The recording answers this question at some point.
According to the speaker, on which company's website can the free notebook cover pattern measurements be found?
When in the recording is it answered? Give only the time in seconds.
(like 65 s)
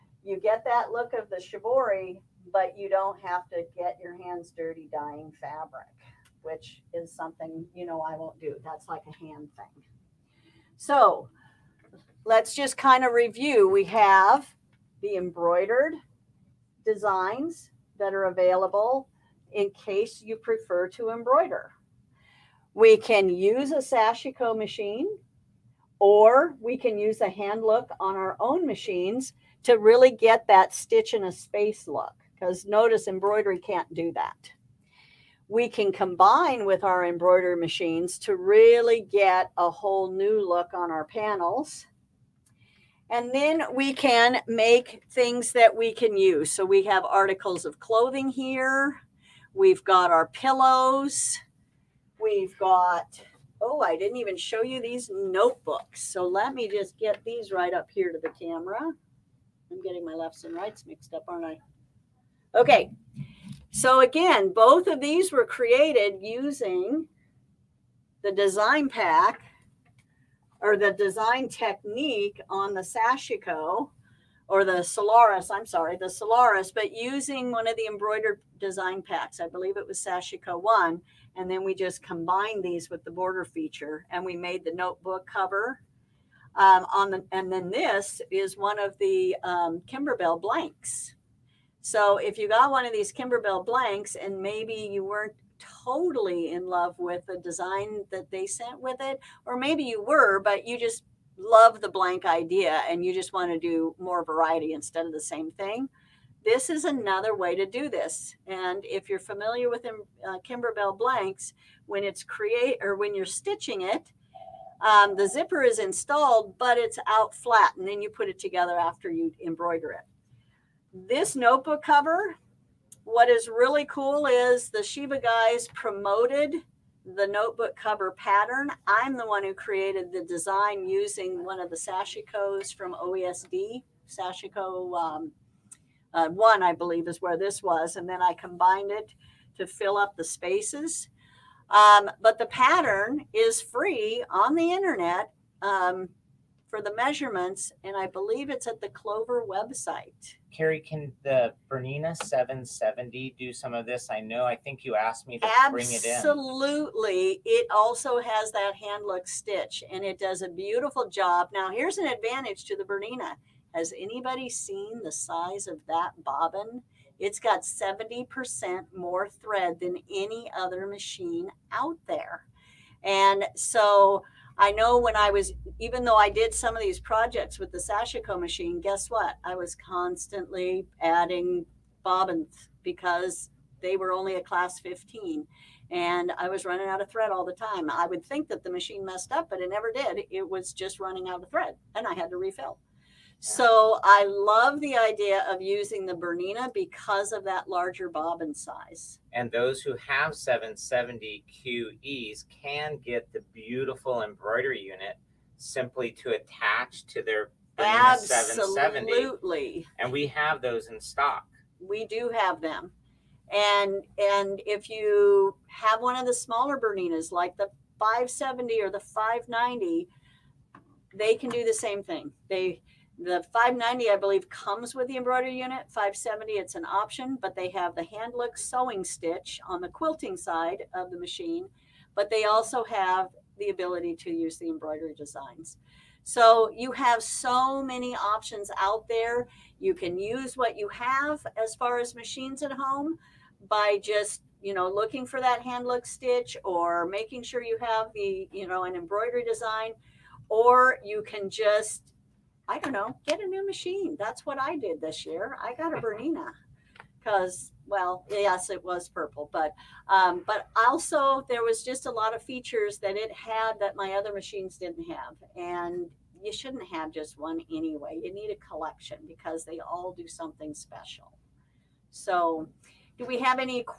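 148 s.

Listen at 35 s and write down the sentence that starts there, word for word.
We can combine with our embroidery machines to really get a whole new look on our panels.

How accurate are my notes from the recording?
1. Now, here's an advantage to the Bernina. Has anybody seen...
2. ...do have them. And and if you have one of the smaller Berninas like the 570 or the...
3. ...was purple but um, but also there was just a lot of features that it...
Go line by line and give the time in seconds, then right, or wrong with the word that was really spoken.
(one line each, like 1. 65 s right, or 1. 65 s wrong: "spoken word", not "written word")
1. 161 s right
2. 212 s right
3. 258 s right.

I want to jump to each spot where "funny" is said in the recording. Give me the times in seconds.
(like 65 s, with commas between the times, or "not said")
not said.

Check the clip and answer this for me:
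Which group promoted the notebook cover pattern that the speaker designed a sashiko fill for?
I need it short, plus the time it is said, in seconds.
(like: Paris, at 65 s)
Shibaguyz, at 124 s.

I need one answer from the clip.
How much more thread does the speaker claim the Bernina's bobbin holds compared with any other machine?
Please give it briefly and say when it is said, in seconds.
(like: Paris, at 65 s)
70%, at 167 s.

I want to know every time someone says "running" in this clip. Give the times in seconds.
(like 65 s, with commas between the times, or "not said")
186 s, 190 s.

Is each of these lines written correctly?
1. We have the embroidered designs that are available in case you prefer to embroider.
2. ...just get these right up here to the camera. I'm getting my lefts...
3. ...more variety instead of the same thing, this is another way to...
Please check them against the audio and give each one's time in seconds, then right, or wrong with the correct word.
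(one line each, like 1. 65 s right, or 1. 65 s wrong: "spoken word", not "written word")
1. 13 s right
2. 56 s right
3. 103 s right.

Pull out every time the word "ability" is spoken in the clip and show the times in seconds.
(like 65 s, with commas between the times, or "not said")
233 s.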